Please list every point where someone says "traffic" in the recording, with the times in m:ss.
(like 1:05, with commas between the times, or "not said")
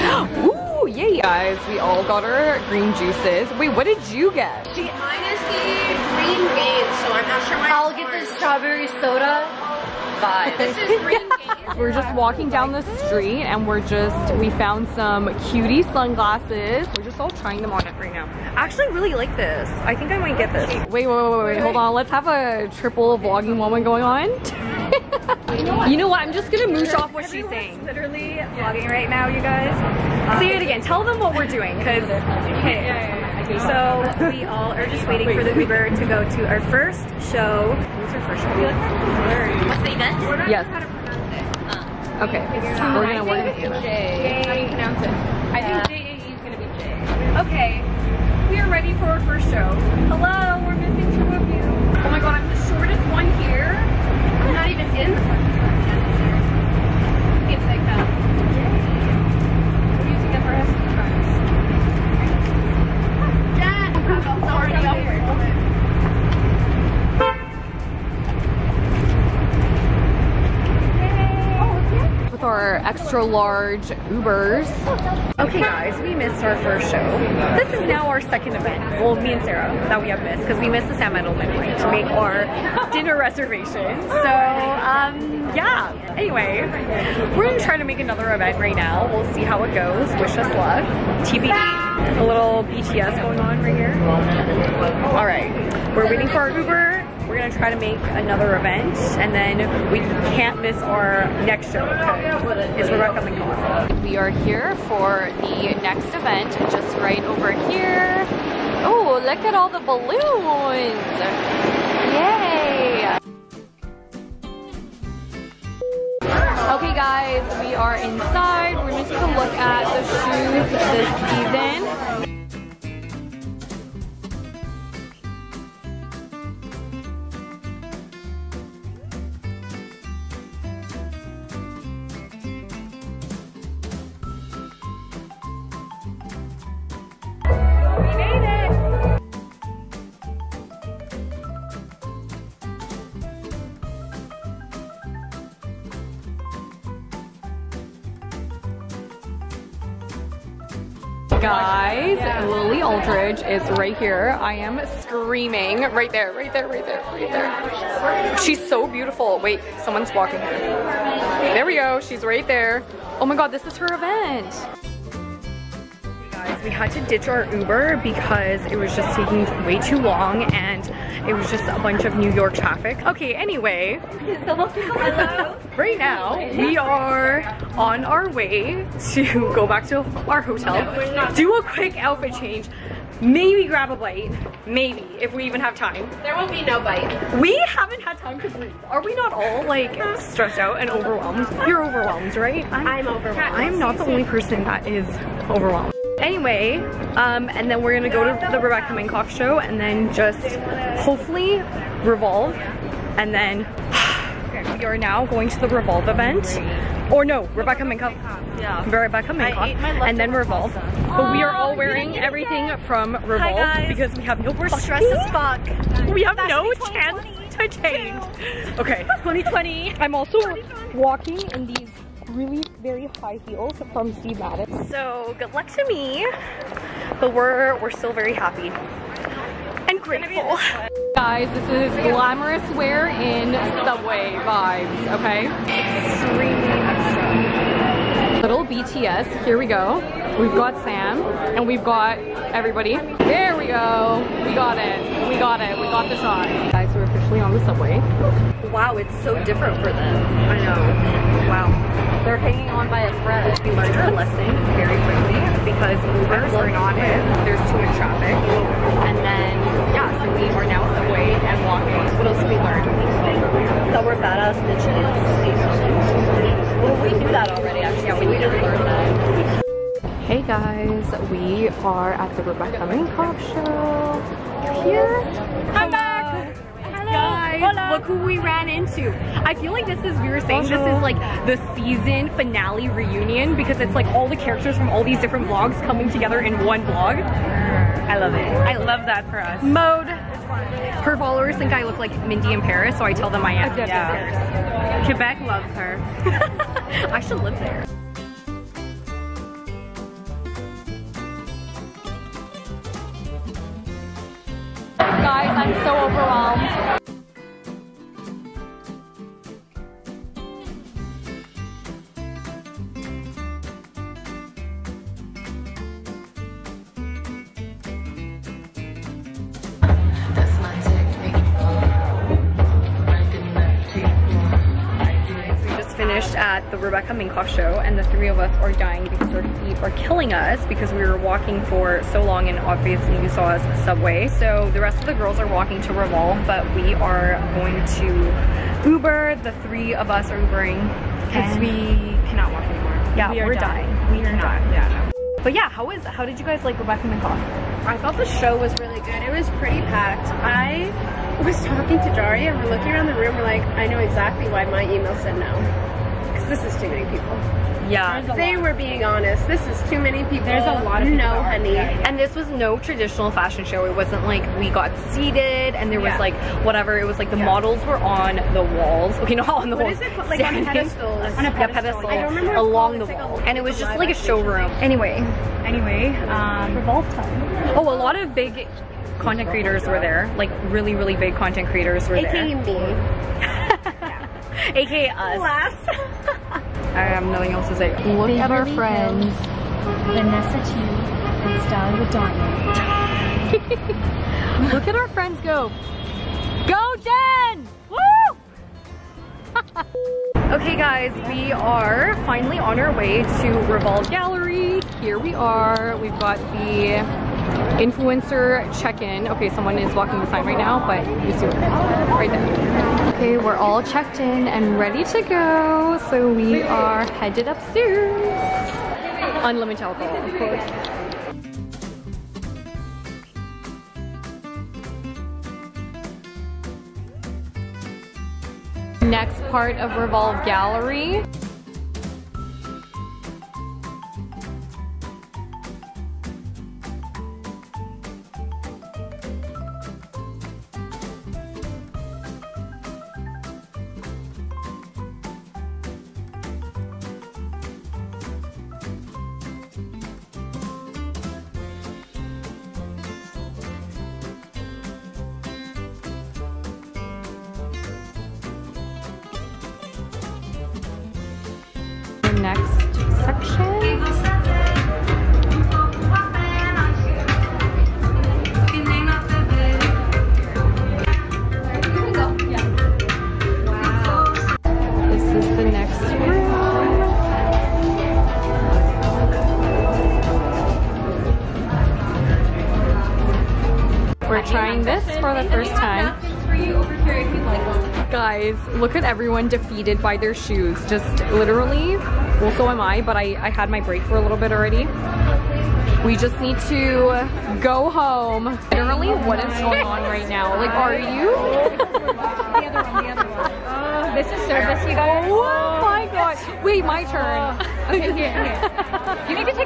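2:52, 4:17.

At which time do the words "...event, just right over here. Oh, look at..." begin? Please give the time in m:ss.
1:46.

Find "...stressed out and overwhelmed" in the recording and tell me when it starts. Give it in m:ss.
3:10.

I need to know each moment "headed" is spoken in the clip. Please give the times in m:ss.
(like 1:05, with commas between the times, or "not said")
6:57.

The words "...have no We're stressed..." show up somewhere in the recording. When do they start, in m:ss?
3:34.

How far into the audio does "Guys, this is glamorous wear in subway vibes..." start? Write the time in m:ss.
3:51.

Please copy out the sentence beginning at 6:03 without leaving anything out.
It wasn't like we got seated and there was yeah.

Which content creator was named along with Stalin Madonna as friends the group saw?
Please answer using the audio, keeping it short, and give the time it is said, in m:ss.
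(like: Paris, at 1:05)
Vanessa Chu, at 6:30.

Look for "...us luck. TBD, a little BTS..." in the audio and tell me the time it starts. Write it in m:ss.
1:30.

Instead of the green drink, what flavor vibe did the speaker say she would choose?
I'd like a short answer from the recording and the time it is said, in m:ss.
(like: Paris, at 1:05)
strawberry soda, at 0:08.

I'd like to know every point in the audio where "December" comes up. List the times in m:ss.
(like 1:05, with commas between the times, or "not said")
not said.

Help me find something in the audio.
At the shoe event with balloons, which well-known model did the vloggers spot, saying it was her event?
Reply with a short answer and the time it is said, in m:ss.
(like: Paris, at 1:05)
Lily Aldridge, at 2:32.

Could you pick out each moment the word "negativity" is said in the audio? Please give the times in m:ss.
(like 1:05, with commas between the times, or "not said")
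not said.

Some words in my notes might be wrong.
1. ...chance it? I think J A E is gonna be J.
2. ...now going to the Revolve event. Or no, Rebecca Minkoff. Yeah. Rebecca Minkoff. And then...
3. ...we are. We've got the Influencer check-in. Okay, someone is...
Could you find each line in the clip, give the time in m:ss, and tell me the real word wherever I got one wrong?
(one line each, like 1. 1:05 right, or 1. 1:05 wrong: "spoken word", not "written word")
1. 0:44 wrong: "pronounce", not "chance"
2. 3:24 right
3. 6:45 right.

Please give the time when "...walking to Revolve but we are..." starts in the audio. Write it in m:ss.
5:35.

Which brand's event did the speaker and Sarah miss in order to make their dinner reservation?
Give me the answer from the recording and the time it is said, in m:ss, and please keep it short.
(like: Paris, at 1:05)
Sam Edelman, at 1:20.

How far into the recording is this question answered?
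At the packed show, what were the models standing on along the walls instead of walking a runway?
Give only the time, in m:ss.
6:10.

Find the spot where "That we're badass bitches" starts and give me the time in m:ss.
4:23.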